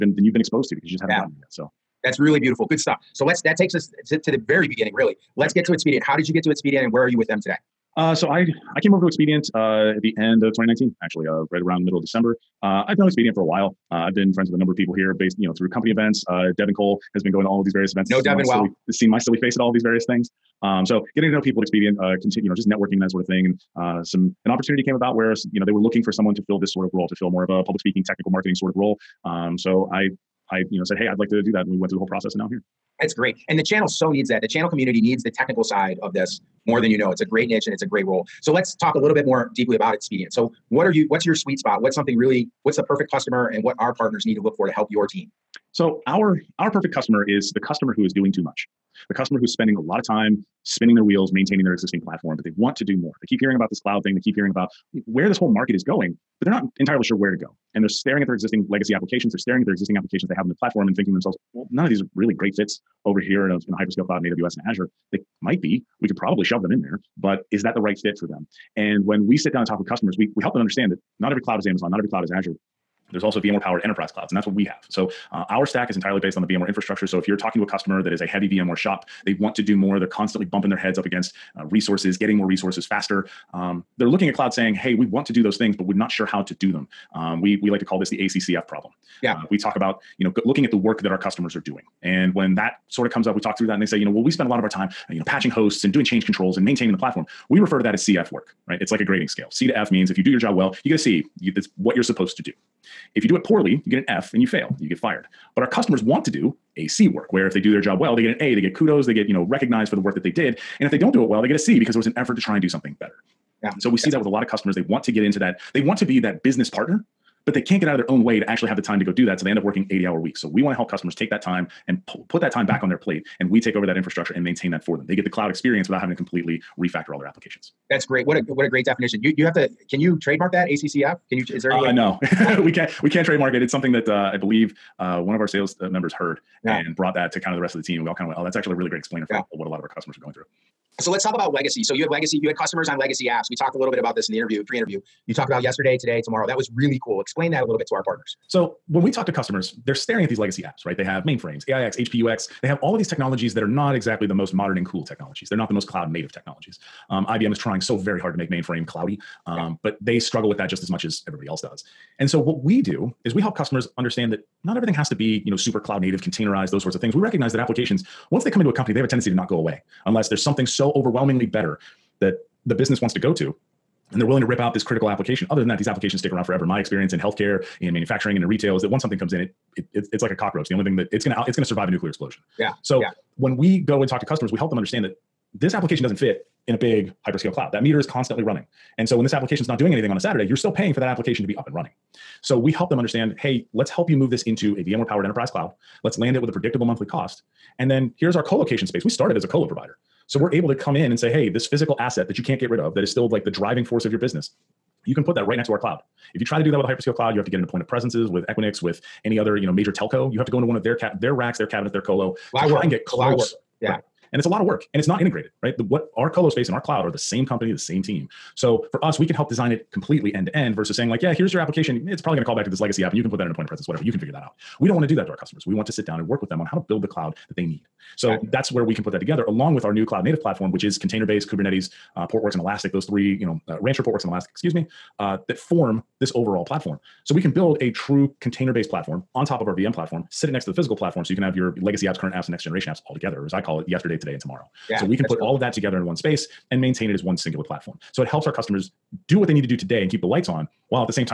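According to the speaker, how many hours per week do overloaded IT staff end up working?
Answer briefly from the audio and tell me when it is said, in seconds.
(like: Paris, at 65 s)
80, at 119 s.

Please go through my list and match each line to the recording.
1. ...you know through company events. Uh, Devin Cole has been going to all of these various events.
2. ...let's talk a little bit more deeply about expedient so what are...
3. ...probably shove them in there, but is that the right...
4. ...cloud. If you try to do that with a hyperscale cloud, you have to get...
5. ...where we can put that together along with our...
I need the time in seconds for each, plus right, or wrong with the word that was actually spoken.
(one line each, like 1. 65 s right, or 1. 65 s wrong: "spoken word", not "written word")
1. 15 s right
2. 38 s right
3. 66 s right
4. 205 s right
5. 228 s right.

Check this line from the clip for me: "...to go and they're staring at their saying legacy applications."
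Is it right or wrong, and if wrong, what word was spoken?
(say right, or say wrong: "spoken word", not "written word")
wrong: "existing", not "saying".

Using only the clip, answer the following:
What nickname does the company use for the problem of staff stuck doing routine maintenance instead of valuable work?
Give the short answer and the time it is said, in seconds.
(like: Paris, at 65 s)
ACCF problem, at 88 s.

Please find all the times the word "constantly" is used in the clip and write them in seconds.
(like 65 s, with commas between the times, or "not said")
80 s, 188 s.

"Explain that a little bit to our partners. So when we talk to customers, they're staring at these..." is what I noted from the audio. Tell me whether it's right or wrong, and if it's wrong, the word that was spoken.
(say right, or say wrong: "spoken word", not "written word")
right.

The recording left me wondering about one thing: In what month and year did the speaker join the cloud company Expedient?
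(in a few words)
December 2019.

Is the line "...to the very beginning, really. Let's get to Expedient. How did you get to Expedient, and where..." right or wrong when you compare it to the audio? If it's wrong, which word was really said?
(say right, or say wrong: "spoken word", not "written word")
right.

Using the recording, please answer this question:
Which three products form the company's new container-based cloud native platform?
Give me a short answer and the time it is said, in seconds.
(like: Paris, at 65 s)
Rancher, Portworx, and Elastic, at 233 s.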